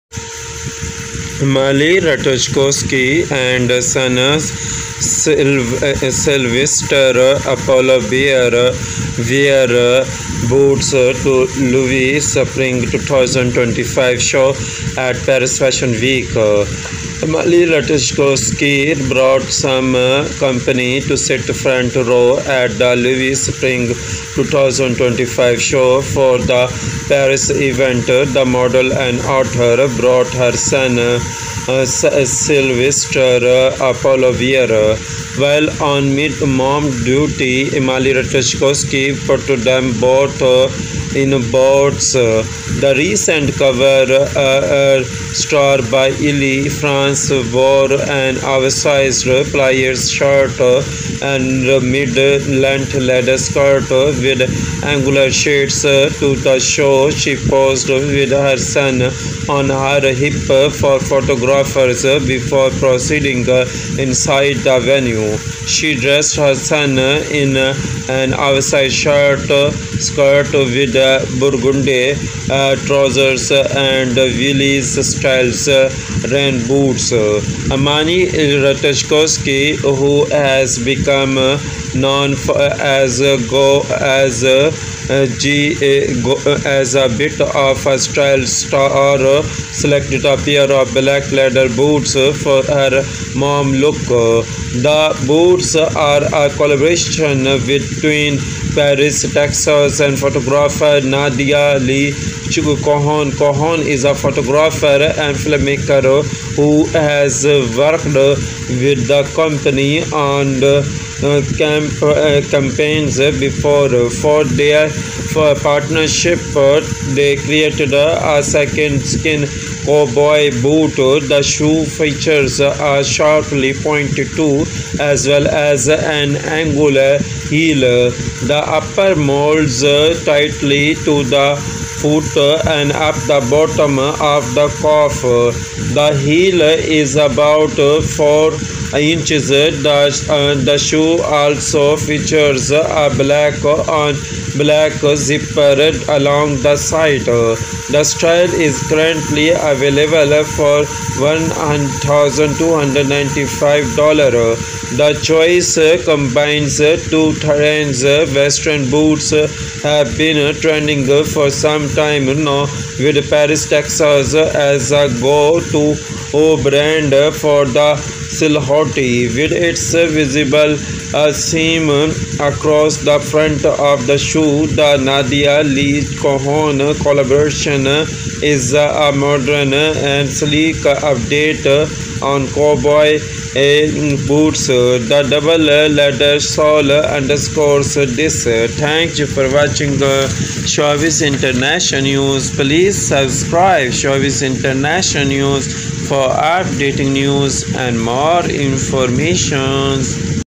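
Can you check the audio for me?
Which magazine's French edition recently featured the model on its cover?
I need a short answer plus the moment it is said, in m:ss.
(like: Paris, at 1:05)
Elle France, at 0:46.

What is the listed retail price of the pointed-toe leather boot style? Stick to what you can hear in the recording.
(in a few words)
$1,295.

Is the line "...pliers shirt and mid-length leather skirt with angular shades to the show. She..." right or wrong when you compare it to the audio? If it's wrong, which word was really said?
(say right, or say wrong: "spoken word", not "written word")
right.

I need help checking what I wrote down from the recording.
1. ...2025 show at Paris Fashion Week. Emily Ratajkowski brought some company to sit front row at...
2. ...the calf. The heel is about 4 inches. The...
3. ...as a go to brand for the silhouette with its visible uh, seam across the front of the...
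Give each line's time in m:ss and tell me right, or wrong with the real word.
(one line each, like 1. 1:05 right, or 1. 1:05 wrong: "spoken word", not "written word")
1. 0:12 right
2. 2:14 right
3. 2:44 right.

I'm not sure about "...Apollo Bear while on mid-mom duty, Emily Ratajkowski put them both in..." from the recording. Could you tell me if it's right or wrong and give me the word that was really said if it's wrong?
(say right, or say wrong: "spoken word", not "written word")
right.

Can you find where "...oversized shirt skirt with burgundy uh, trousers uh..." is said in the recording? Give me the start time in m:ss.
1:08.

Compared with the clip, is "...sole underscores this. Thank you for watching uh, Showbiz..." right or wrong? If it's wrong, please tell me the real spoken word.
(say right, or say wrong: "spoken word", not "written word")
right.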